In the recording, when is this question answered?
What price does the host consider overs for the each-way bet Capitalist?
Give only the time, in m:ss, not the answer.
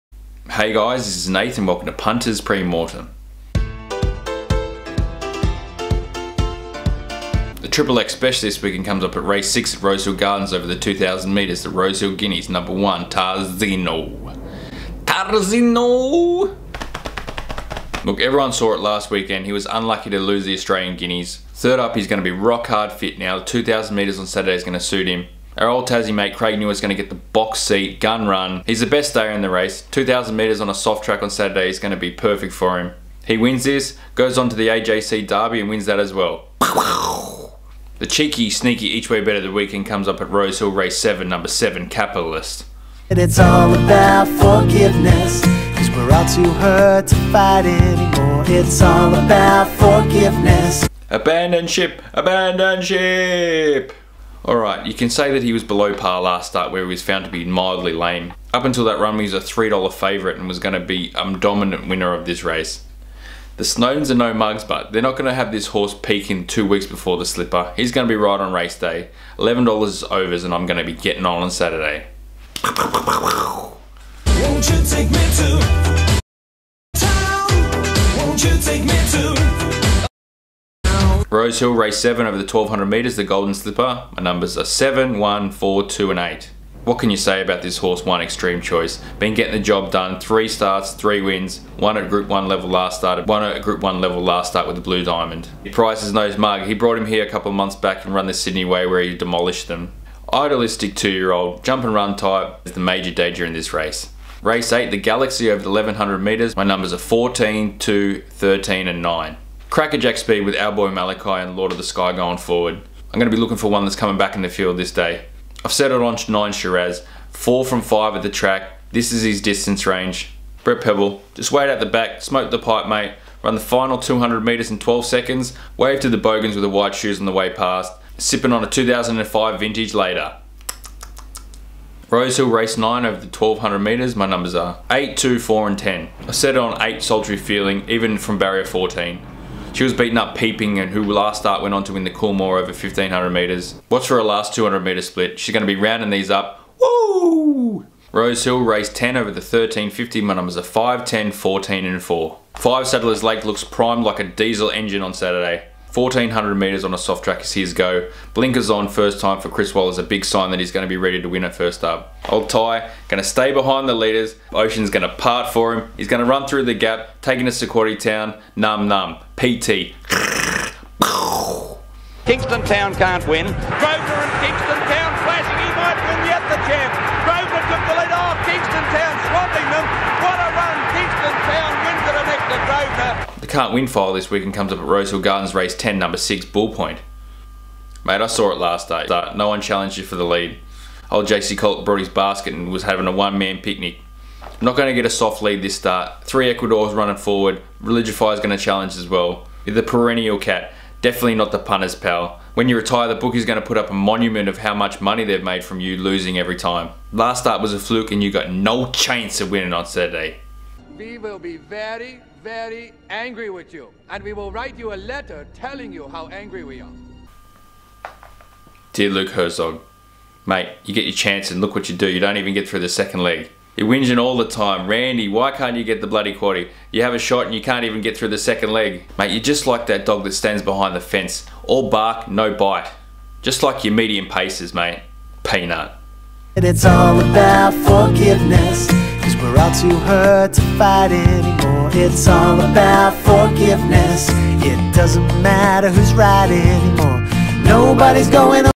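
1:09.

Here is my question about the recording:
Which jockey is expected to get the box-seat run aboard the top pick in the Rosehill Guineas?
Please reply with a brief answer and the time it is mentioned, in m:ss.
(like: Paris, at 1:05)
Craig Newitt, at 0:26.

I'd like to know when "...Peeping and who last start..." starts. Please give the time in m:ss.
2:20.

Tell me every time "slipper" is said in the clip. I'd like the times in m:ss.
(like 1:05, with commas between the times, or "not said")
1:07, 1:23.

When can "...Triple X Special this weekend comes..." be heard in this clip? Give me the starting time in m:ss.
0:07.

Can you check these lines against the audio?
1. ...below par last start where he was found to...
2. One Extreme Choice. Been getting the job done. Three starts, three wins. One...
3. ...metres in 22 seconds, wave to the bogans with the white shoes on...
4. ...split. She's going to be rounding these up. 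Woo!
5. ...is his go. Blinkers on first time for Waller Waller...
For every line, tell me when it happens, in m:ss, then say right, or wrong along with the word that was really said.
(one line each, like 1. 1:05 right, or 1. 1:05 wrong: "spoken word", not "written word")
1. 0:55 right
2. 1:28 right
3. 2:04 wrong: "12", not "22"
4. 2:25 right
5. 2:37 wrong: "Chris", not "Waller".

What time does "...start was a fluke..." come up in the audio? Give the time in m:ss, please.
3:27.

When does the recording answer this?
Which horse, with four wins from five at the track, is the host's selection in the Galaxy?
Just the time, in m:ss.
1:56.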